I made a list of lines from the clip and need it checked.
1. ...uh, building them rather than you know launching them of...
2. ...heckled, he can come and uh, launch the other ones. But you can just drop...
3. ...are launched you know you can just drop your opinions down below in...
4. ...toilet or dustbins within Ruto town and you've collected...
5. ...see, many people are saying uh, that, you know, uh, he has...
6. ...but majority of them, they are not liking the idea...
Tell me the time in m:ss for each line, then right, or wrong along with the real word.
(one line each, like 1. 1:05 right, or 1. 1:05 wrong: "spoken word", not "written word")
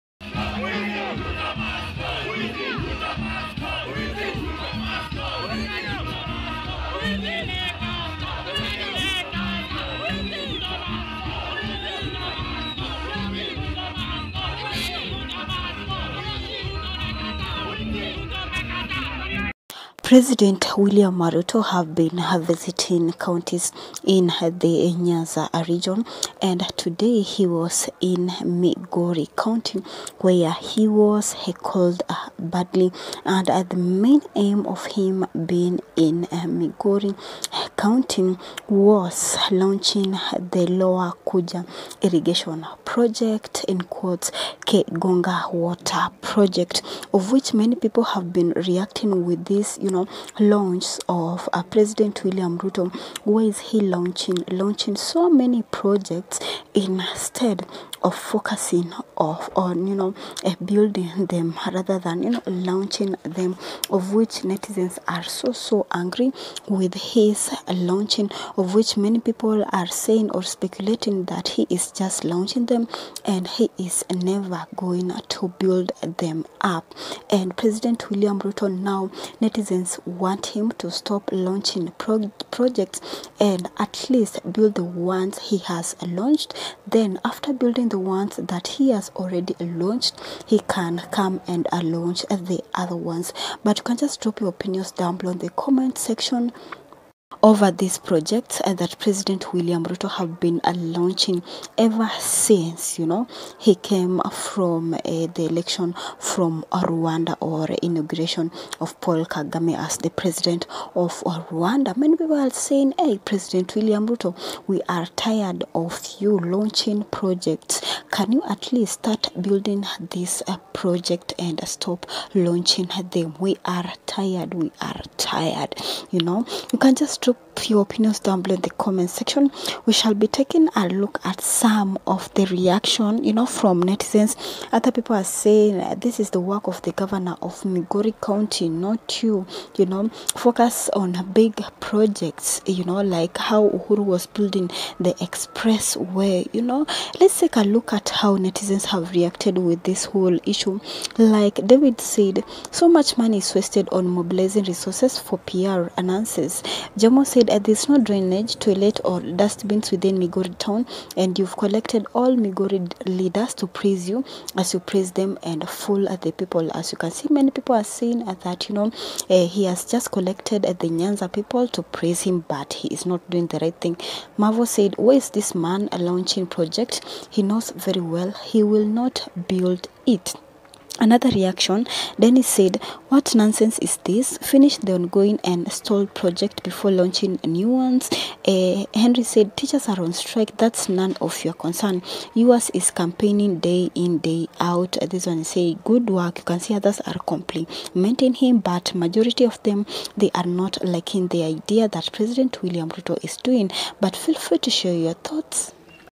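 1. 1:00 right
2. 1:29 wrong: "launched", not "heckled"
3. 2:04 wrong: "tired", not "launched"
4. 2:38 wrong: "Migori", not "Ruto"
5. 2:47 right
6. 3:18 right.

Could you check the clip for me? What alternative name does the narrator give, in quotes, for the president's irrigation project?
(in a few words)
Kegonga water project.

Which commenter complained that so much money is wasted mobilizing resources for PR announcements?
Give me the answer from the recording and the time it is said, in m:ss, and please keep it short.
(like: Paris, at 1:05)
David, at 2:31.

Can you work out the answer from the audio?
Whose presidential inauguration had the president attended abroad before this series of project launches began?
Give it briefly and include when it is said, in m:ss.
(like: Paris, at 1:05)
Paul Kagame, at 1:49.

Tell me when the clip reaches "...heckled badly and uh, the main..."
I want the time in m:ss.
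0:31.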